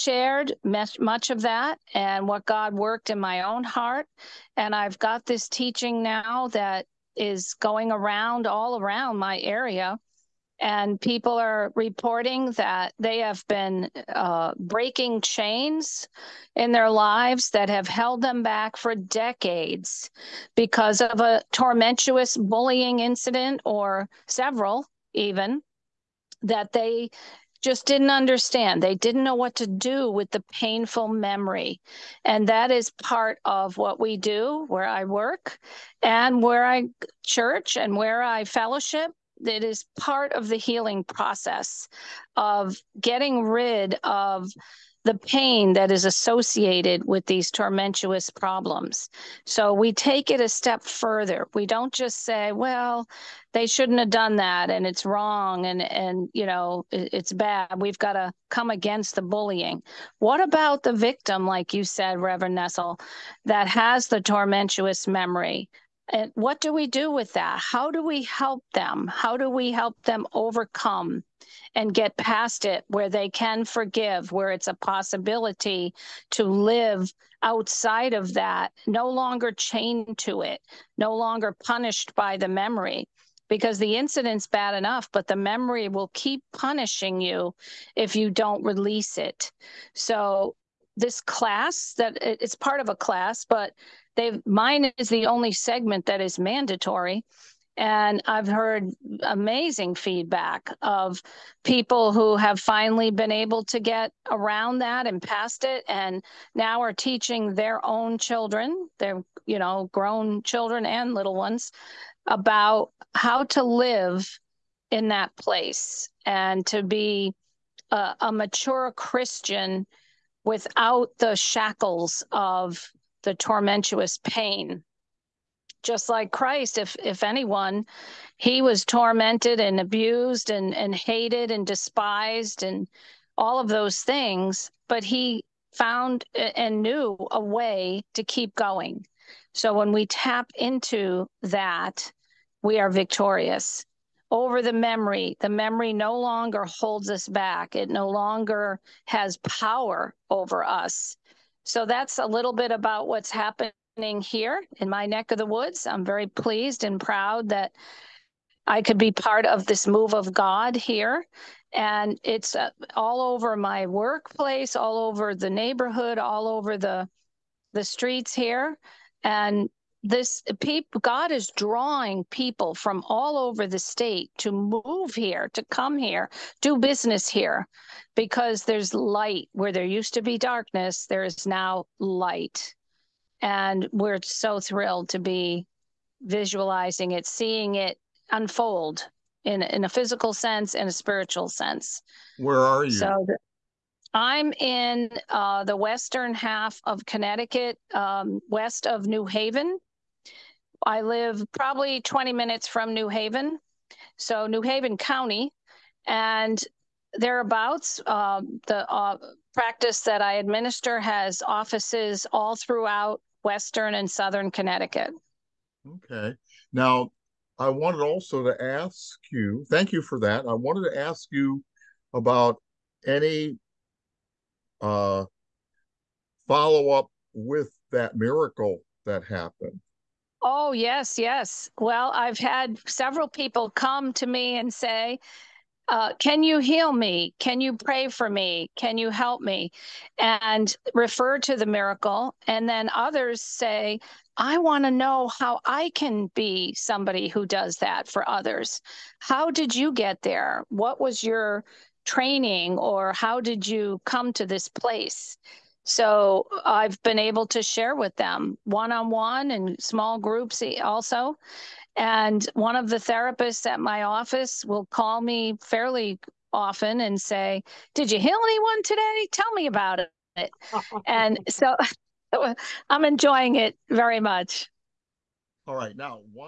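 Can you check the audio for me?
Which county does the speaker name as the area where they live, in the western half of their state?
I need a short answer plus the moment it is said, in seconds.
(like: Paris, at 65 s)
New Haven County, at 204 s.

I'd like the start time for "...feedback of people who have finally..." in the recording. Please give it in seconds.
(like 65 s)
99 s.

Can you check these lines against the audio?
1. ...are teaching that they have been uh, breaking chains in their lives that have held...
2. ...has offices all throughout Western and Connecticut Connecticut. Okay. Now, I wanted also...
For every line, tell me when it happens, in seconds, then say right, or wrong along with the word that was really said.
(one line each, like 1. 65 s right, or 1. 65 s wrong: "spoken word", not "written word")
1. 11 s wrong: "reporting", not "teaching"
2. 210 s wrong: "Southern", not "Connecticut".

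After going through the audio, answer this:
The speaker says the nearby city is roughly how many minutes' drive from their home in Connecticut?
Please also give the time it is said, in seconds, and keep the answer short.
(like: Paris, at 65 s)
20, at 202 s.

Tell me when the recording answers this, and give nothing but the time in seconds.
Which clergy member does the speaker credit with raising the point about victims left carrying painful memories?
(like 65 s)
62 s.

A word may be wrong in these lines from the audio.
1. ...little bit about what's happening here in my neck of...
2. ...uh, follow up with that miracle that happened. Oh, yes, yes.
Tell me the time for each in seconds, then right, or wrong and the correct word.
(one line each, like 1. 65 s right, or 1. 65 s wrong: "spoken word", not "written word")
1. 152 s right
2. 224 s right.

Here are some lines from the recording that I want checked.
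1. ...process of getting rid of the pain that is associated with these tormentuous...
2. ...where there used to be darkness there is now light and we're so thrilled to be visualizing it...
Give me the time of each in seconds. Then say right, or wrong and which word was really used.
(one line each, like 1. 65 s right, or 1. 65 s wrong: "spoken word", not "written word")
1. 41 s right
2. 179 s right.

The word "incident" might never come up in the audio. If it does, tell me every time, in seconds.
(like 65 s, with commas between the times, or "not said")
22 s, 83 s.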